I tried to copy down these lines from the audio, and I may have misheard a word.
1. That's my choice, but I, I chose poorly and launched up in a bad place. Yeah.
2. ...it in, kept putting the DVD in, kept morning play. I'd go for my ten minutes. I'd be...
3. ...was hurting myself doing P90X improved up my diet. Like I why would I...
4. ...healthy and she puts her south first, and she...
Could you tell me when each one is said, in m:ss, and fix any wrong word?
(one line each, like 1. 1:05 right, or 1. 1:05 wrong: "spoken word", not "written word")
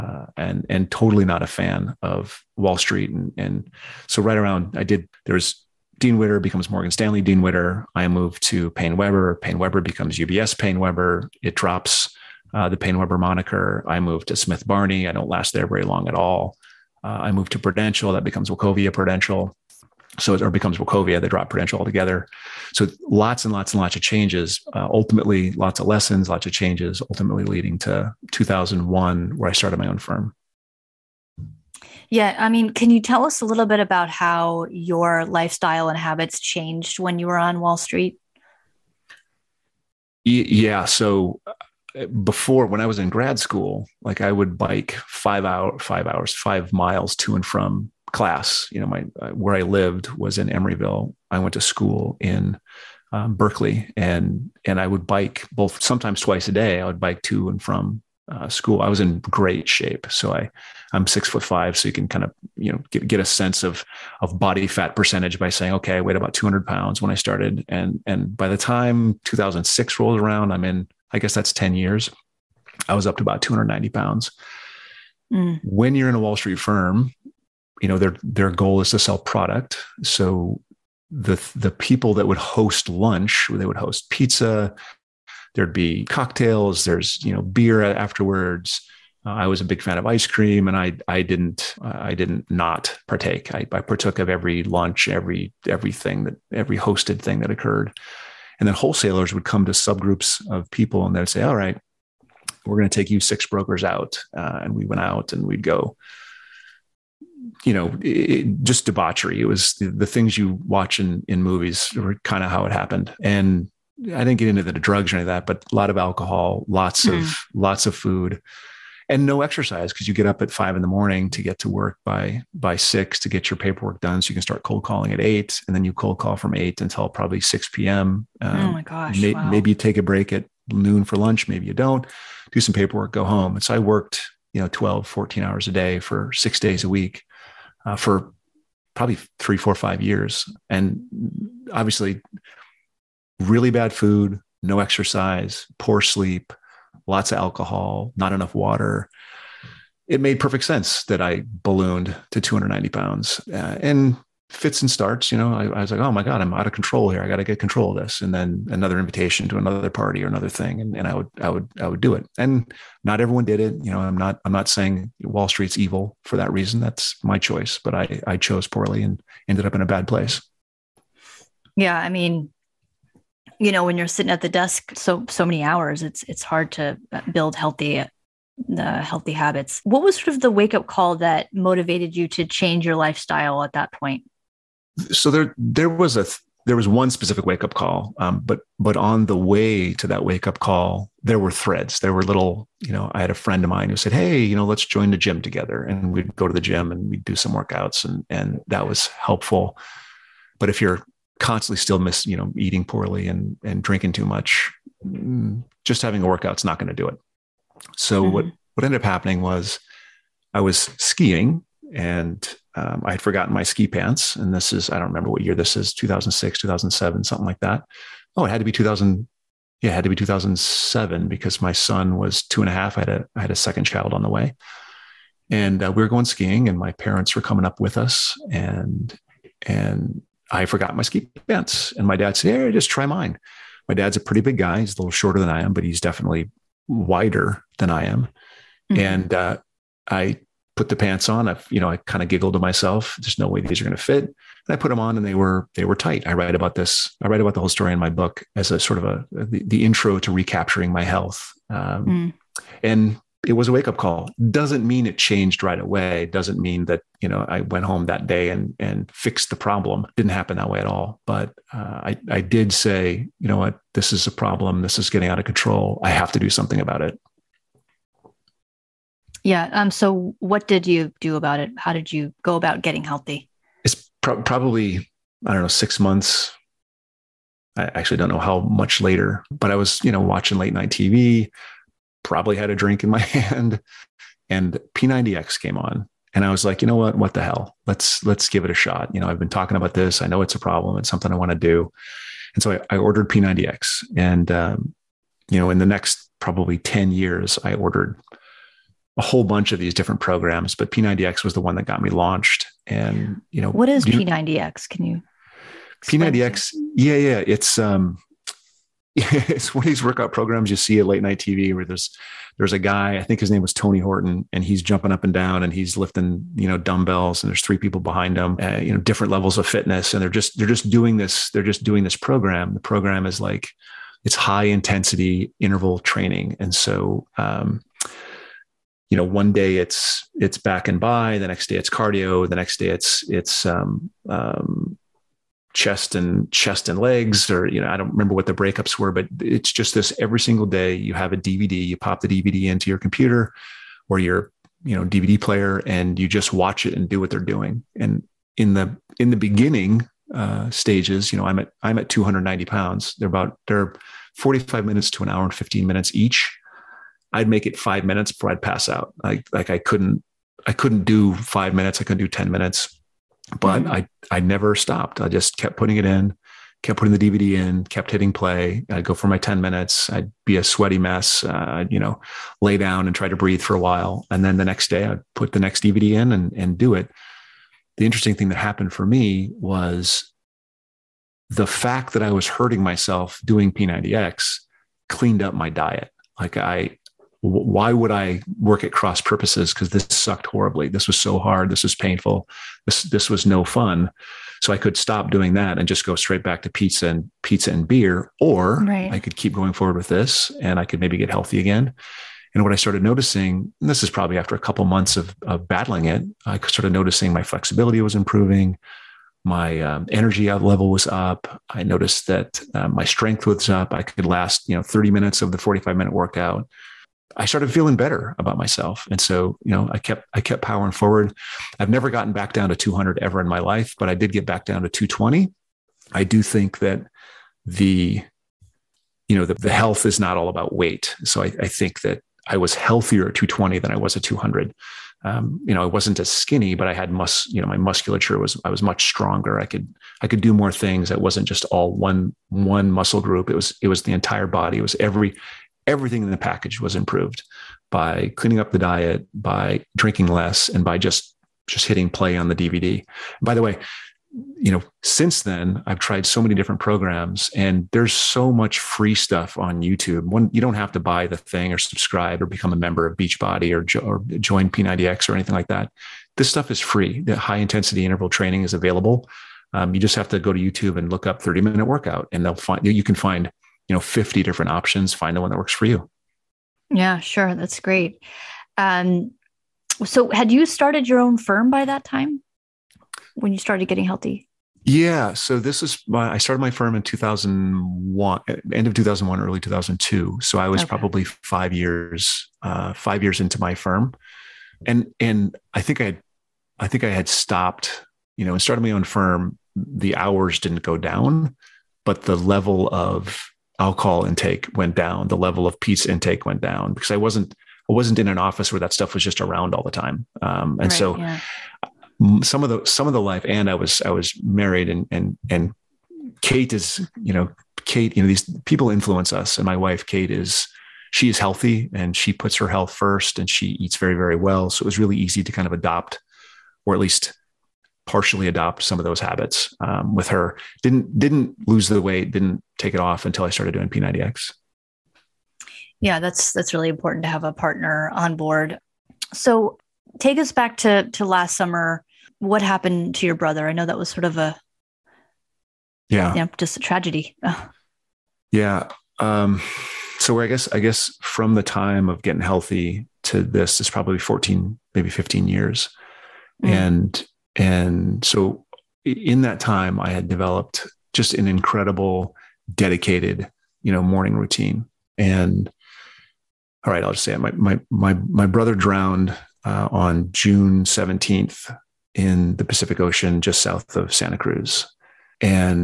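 1. 2:46 wrong: "ended", not "launched"
2. 6:05 wrong: "hitting", not "morning"
3. 6:22 wrong: "cleaned", not "improved"
4. 8:41 wrong: "health", not "south".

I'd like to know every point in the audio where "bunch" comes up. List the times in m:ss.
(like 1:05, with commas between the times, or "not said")
4:59.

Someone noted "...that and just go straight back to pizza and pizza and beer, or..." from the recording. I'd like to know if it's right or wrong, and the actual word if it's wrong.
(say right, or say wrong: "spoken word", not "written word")
right.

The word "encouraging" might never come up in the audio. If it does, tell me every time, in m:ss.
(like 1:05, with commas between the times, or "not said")
not said.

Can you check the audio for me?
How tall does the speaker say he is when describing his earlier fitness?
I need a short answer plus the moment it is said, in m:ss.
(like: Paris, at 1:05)
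6 foot 5, at 1:01.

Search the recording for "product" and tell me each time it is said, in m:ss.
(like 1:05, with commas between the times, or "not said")
1:19.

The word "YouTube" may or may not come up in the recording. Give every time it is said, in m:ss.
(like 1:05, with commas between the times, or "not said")
7:39, 7:50.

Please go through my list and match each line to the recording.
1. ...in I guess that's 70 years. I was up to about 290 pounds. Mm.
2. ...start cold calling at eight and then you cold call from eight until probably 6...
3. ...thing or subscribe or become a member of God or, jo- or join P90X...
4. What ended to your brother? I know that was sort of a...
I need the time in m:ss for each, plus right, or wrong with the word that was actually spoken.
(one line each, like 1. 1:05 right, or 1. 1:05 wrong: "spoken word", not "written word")
1. 1:10 wrong: "10", not "70"
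2. 2:04 right
3. 7:41 wrong: "Beachbody", not "God"
4. 9:02 wrong: "happened", not "ended".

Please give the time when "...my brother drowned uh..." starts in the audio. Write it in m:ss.
9:28.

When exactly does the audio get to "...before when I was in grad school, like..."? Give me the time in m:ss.
0:42.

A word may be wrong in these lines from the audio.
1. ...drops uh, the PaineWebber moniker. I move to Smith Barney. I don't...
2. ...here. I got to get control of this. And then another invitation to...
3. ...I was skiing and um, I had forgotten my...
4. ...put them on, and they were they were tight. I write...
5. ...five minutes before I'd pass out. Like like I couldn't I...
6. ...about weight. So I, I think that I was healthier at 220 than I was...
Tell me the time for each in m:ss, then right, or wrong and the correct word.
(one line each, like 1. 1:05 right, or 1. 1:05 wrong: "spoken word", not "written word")
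1. 0:11 right
2. 2:37 right
3. 3:30 right
4. 4:04 right
5. 5:57 right
6. 7:10 right.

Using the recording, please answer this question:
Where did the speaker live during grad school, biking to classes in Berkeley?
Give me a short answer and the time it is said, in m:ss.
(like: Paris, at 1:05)
Emeryville, at 0:50.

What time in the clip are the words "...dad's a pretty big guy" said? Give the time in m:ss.
3:53.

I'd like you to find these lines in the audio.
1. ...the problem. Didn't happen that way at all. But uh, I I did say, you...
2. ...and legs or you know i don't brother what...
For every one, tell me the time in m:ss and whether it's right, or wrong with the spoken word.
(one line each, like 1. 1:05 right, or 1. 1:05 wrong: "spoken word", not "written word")
1. 4:19 right
2. 5:36 wrong: "remember", not "brother".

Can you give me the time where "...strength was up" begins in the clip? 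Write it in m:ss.
6:53.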